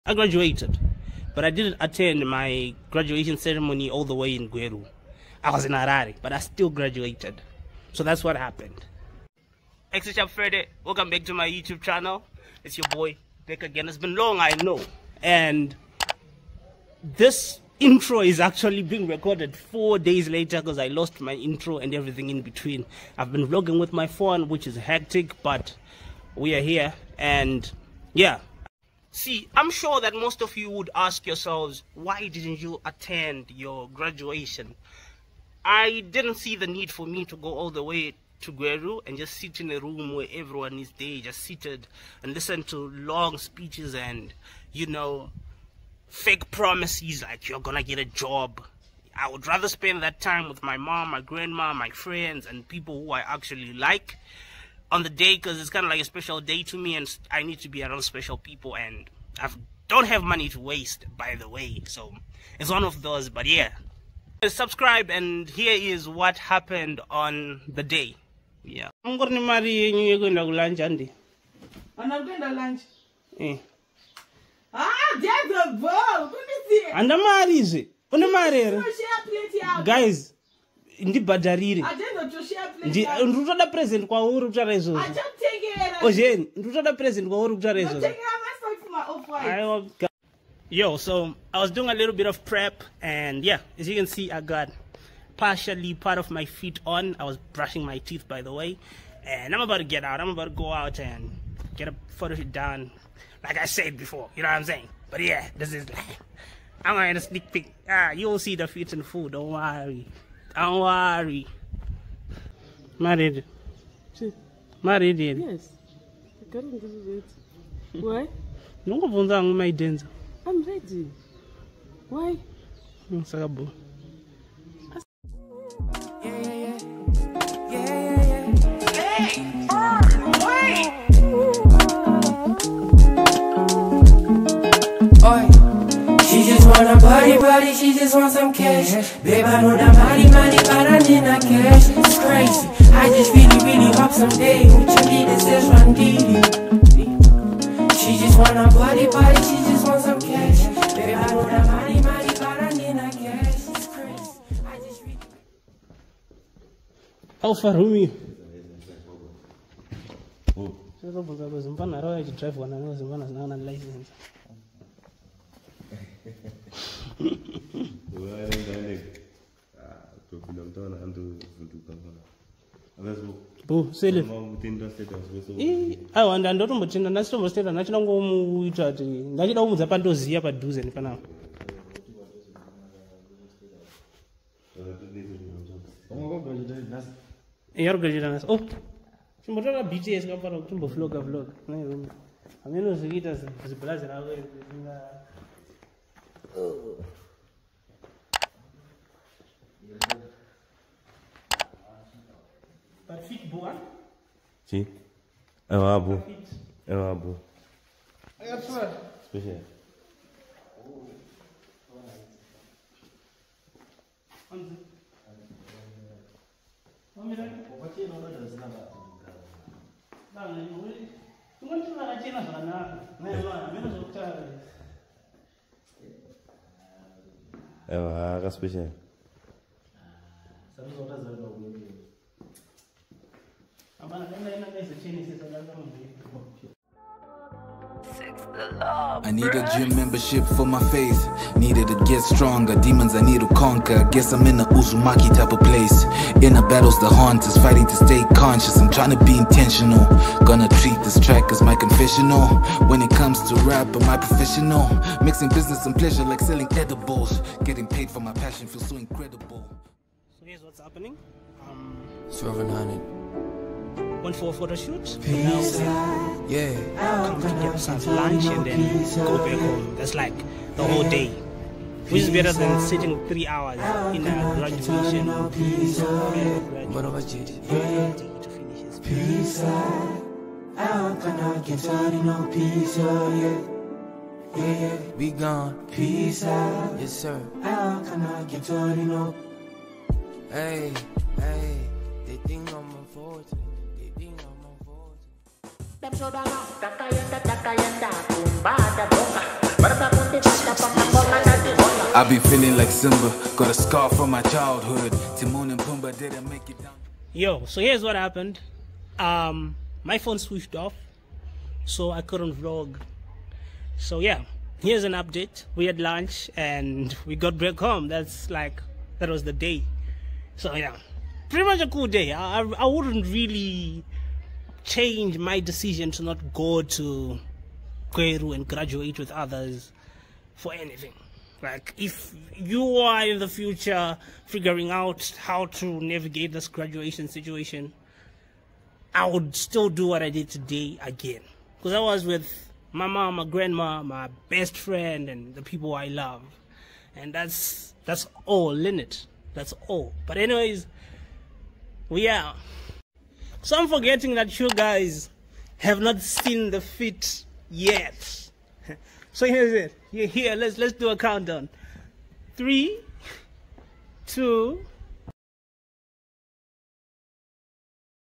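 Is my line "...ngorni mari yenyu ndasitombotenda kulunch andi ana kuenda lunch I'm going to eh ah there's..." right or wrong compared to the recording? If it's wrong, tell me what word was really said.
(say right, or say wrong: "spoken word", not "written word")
wrong: "yekwenda", not "ndasitombotenda".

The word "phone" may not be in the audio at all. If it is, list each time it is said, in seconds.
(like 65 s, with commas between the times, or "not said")
24 s, 310 s.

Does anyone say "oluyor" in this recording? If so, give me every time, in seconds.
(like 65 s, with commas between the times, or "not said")
220 s, 231 s.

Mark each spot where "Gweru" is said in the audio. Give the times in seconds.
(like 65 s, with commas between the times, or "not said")
4 s, 38 s, 328 s.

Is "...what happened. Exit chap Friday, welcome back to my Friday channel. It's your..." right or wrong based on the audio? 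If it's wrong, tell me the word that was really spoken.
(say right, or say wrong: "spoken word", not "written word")
wrong: "YouTube", not "Friday".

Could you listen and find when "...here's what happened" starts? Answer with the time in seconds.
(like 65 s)
307 s.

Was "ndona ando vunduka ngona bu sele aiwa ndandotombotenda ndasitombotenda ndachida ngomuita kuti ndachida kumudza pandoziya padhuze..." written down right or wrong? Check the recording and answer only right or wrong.
right.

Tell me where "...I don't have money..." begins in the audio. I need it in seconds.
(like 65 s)
59 s.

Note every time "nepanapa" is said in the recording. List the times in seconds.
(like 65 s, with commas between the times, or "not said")
180 s.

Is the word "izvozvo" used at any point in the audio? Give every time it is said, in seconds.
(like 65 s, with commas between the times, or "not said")
83 s, 89 s.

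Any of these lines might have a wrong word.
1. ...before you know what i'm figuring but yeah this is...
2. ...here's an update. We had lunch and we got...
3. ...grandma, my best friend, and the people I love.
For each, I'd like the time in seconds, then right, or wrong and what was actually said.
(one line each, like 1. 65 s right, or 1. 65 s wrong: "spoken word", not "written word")
1. 103 s wrong: "saying", not "figuring"
2. 314 s right
3. 343 s right.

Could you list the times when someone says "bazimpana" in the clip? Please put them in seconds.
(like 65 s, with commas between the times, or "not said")
161 s.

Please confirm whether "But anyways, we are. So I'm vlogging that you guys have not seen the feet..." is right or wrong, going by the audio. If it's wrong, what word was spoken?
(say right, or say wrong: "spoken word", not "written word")
wrong: "forgetting", not "vlogging".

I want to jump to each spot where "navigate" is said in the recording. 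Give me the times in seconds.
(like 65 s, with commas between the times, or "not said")
336 s.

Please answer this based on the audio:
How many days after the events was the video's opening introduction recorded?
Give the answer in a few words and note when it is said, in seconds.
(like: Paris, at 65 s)
4, at 19 s.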